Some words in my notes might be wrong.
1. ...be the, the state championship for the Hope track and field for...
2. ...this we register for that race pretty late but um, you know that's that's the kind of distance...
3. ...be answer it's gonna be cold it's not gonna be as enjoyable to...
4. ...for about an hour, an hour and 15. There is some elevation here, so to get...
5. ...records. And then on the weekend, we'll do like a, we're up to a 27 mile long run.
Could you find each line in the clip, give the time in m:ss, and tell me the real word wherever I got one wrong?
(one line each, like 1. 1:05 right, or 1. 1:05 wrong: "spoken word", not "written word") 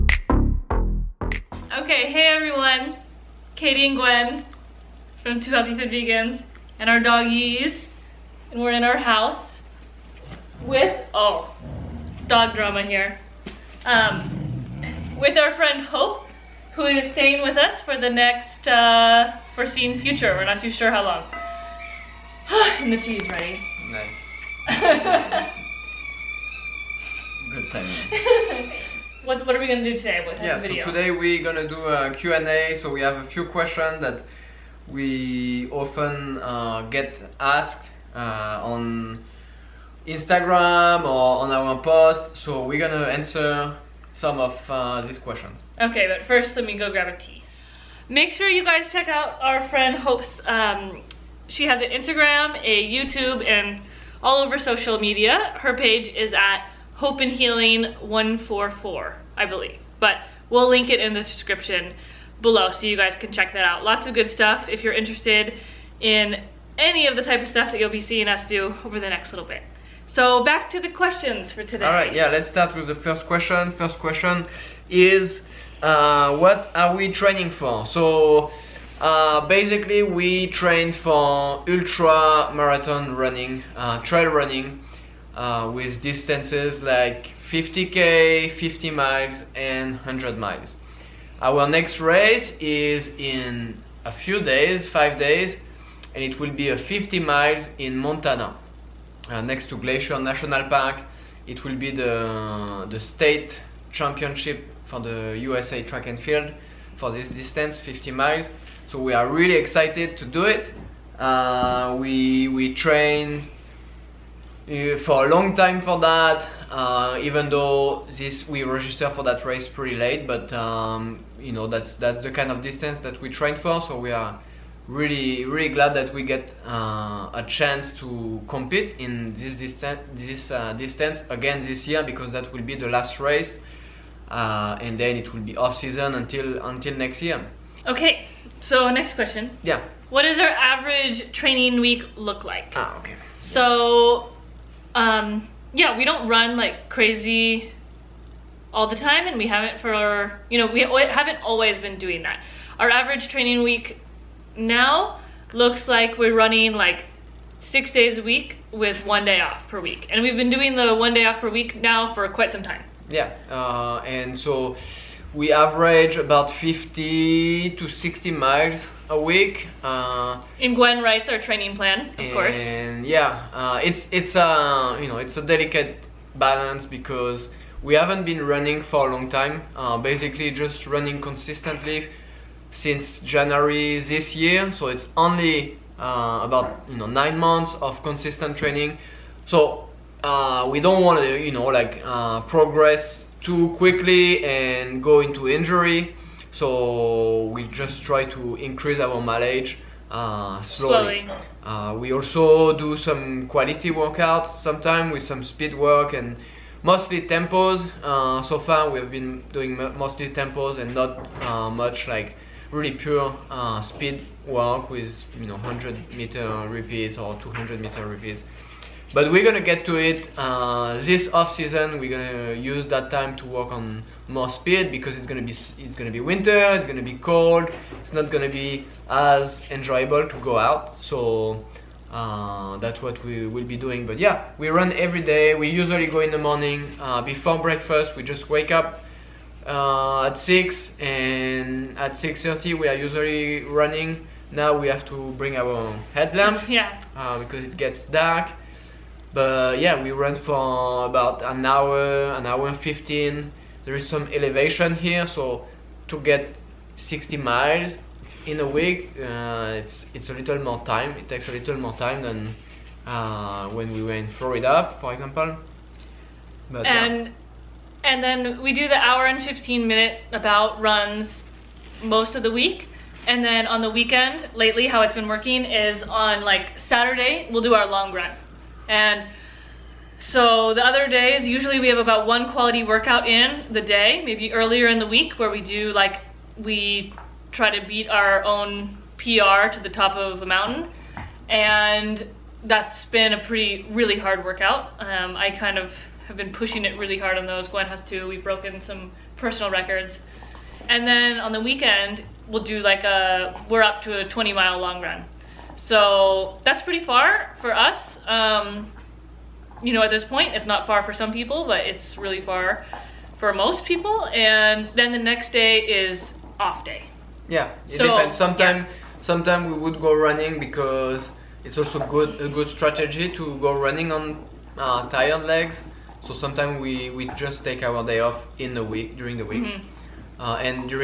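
1. 1:41 wrong: "USA", not "Hope"
2. 1:58 right
3. 3:46 wrong: "winter", not "answer"
4. 4:10 right
5. 4:59 wrong: "20", not "27".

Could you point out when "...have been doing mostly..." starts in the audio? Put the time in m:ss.
3:28.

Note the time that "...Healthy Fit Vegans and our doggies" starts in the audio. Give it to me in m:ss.
0:05.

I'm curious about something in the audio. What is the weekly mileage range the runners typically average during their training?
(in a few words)
50 to 60 miles.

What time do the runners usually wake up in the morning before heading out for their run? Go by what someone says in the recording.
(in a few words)
6.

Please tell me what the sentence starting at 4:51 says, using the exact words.
And that's been a pretty, really hard workout.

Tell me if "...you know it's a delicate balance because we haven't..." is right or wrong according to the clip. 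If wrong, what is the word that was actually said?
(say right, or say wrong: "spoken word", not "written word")
right.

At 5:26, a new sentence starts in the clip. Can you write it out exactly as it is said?
So sometimes we we just take our day off in the week during the week.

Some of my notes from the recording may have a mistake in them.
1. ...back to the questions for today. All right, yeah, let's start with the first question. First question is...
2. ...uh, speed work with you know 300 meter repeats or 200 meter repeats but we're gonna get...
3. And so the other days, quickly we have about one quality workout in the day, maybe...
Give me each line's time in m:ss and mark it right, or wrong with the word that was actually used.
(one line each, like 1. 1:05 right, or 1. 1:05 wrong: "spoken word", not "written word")
1. 1:10 right
2. 3:33 wrong: "100", not "300"
3. 4:38 wrong: "usually", not "quickly".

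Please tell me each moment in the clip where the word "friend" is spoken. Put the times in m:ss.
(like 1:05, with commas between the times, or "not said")
0:15, 0:49.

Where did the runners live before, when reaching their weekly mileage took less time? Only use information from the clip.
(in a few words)
Florida.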